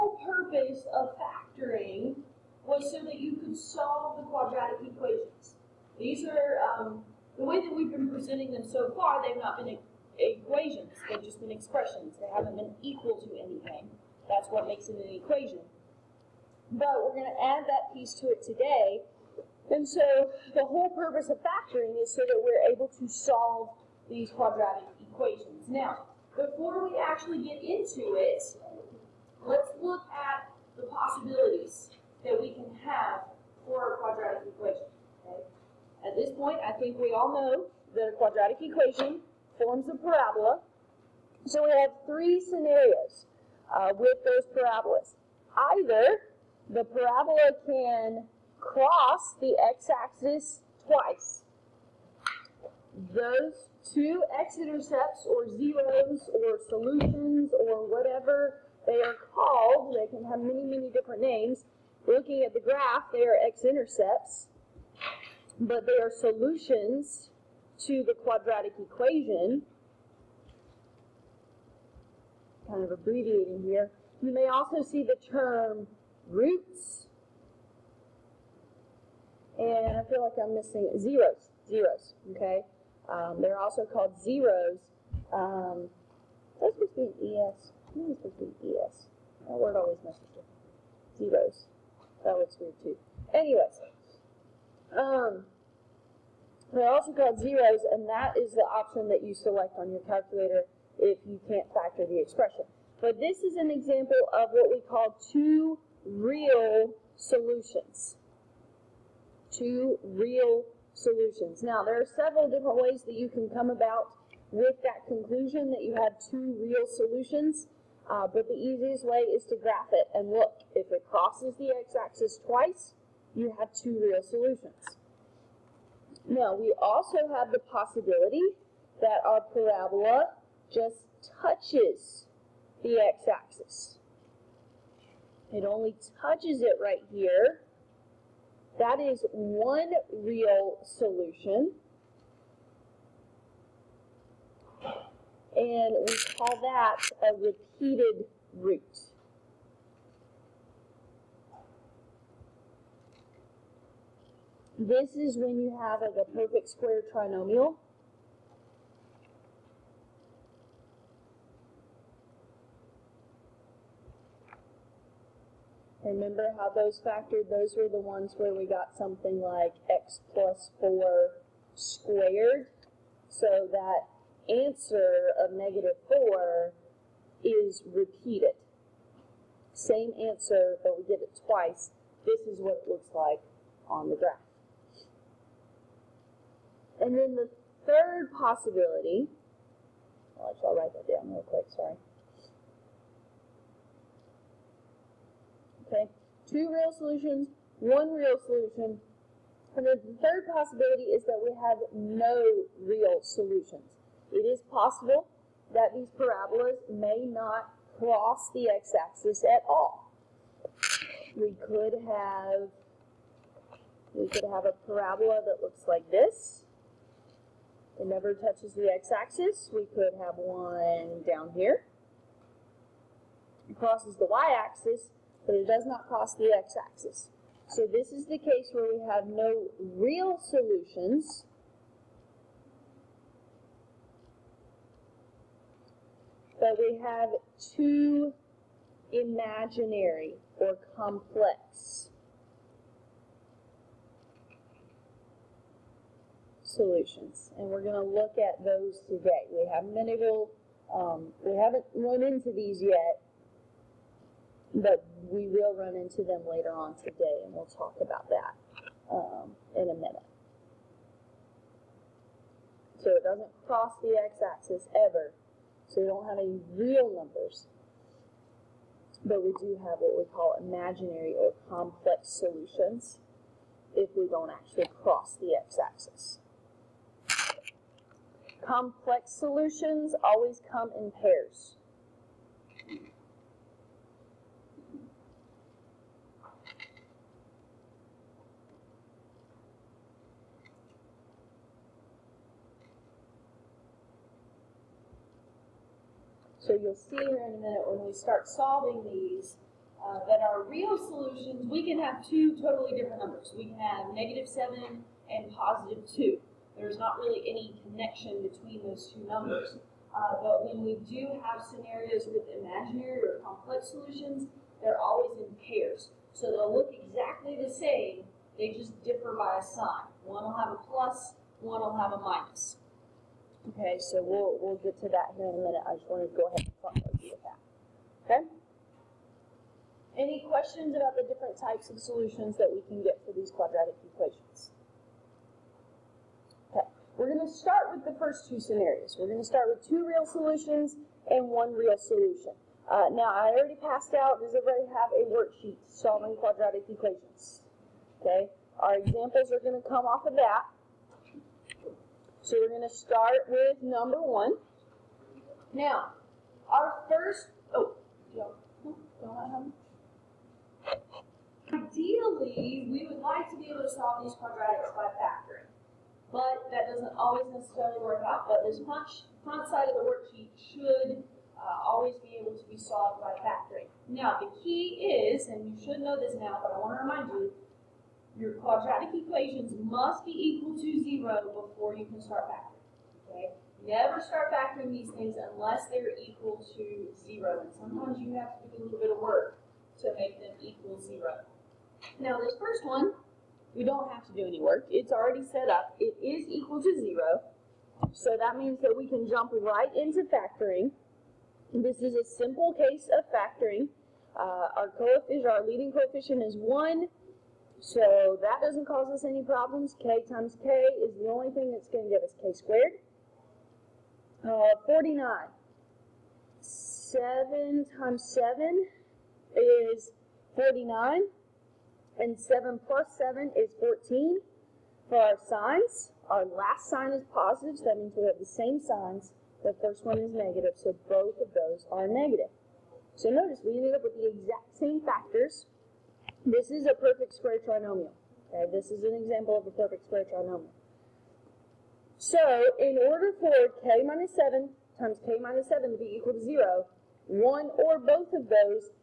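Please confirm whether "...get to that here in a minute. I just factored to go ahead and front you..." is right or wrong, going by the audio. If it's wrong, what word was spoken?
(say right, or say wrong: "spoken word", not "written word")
wrong: "wanted", not "factored".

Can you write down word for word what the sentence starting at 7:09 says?
The first one is negative, so both of those are negative.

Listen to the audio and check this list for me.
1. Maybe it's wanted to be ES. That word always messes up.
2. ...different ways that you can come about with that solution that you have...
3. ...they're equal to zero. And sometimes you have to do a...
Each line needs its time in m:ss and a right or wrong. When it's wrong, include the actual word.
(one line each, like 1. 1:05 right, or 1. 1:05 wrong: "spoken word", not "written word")
1. 1:27 wrong: "supposed", not "wanted"
2. 1:52 wrong: "conclusion", not "solution"
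3. 6:25 right.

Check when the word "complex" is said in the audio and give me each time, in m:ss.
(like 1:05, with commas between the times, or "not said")
4:00, 4:31, 4:38, 5:13.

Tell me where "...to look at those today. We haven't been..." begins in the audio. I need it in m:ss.
4:07.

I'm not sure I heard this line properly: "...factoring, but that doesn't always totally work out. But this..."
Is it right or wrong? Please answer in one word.
wrong.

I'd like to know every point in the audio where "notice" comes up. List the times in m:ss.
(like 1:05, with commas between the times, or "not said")
7:13.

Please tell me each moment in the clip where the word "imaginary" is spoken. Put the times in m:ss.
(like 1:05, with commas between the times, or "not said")
3:59, 4:30, 5:12.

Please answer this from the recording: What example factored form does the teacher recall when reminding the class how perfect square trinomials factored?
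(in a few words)
x plus 4 squared.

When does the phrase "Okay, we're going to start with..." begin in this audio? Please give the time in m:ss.
5:36.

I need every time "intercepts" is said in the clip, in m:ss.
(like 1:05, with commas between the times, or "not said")
0:54, 1:03.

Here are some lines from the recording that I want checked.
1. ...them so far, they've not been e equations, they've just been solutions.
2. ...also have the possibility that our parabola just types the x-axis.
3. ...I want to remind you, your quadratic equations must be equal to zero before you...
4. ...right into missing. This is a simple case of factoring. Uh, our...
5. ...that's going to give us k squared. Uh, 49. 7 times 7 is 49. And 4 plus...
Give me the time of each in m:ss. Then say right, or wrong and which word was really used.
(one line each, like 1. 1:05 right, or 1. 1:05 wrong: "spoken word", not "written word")
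1. 0:08 wrong: "expressions", not "solutions"
2. 2:06 wrong: "touches", not "types"
3. 6:16 right
4. 6:39 wrong: "factoring", not "missing"
5. 6:51 wrong: "7", not "4".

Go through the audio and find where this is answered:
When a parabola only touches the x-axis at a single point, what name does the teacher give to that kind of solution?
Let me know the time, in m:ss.
2:27.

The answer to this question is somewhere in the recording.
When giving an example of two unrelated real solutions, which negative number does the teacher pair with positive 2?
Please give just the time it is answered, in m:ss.
5:04.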